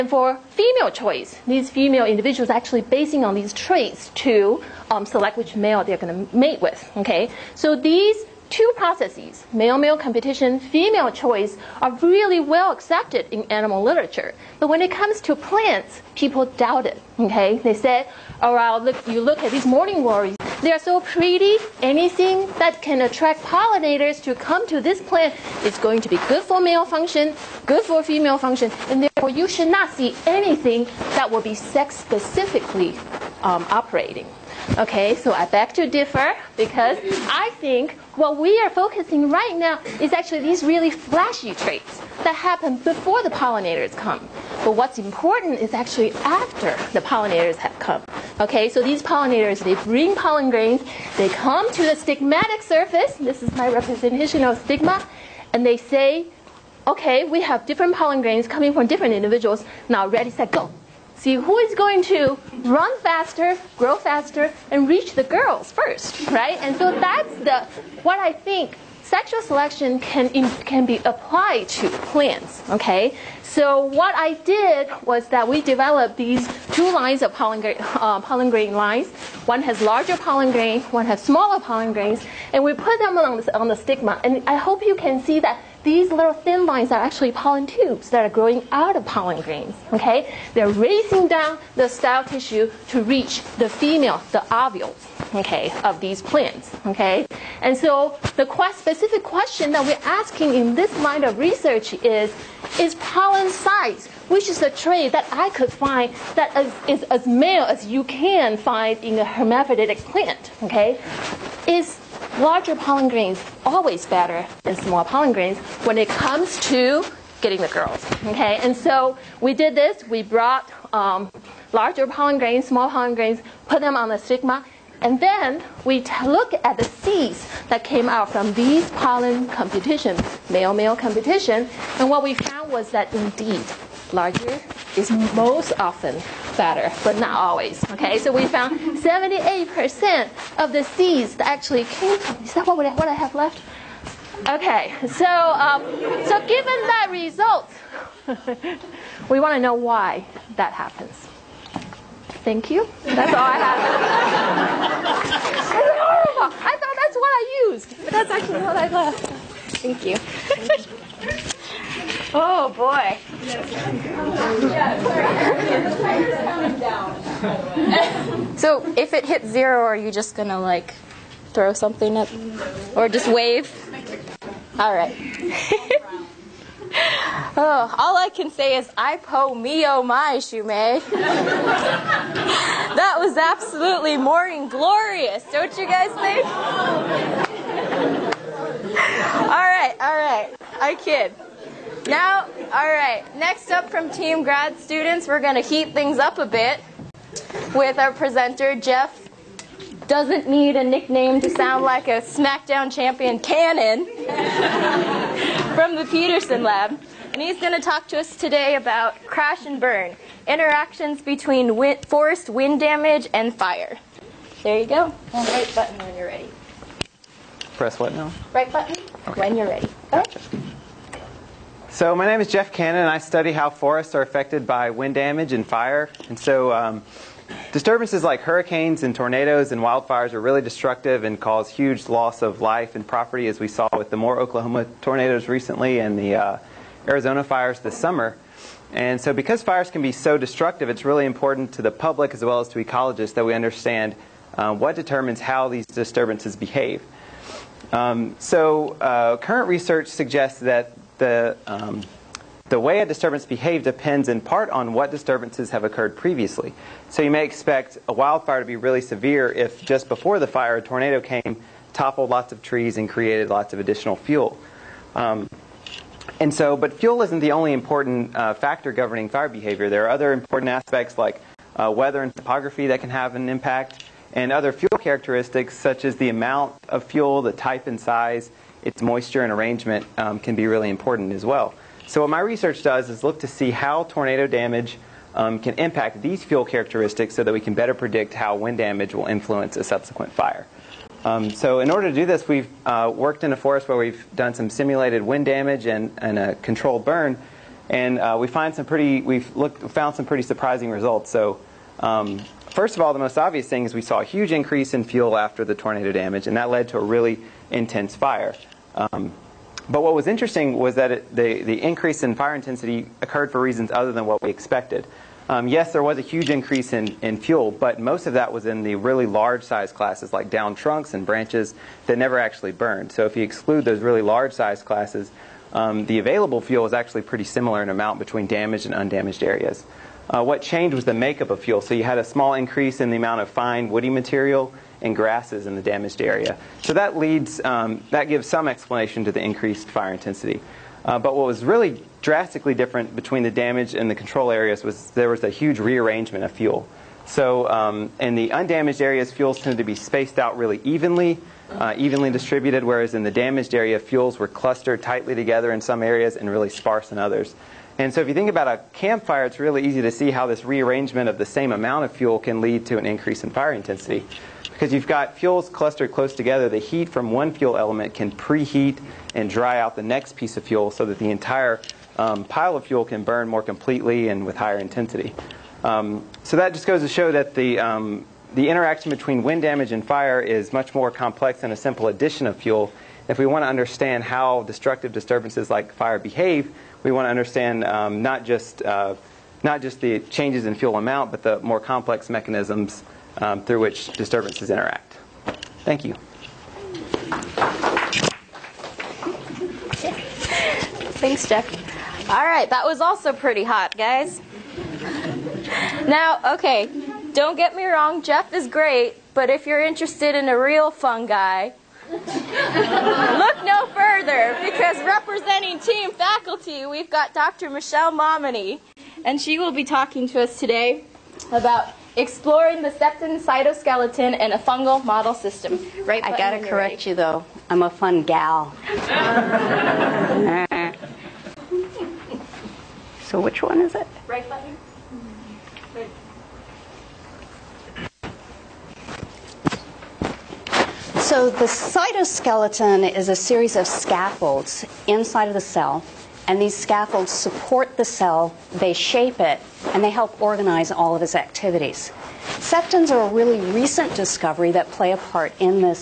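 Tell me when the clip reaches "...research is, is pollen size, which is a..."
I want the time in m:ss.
1:41.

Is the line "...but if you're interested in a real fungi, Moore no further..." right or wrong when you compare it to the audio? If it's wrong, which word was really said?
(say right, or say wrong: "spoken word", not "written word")
wrong: "Look", not "Moore".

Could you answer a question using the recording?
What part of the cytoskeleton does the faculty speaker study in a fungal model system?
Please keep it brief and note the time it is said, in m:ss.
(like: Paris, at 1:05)
septin, at 7:02.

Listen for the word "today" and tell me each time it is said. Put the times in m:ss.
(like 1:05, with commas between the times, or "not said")
3:28, 7:00.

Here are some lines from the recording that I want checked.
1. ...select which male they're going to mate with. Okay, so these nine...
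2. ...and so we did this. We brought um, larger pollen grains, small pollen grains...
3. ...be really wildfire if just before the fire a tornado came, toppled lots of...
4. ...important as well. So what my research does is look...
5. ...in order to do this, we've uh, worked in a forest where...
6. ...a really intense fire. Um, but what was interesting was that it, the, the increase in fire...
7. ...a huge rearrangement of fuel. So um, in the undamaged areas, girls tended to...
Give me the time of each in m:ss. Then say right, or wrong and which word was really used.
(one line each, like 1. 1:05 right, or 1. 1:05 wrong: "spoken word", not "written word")
1. 0:05 wrong: "two", not "nine"
2. 1:58 right
3. 4:18 wrong: "severe", not "wildfire"
4. 4:40 right
5. 4:51 right
6. 5:06 right
7. 5:45 wrong: "fuels", not "girls".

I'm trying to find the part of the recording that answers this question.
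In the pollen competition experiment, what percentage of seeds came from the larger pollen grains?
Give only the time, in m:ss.
2:18.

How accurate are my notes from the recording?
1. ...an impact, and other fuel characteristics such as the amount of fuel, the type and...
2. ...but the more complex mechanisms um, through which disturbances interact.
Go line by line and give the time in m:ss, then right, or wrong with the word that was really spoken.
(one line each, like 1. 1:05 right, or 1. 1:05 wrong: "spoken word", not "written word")
1. 4:33 right
2. 6:31 right.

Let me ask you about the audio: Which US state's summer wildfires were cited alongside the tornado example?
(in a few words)
Arizona.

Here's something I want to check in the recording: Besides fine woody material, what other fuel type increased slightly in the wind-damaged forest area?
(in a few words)
grasses.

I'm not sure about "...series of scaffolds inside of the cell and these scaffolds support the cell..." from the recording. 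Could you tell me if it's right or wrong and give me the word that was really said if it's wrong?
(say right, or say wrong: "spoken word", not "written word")
right.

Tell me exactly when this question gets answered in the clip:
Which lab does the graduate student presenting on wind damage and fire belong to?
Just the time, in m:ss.
3:26.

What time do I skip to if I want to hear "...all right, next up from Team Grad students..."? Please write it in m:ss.
3:12.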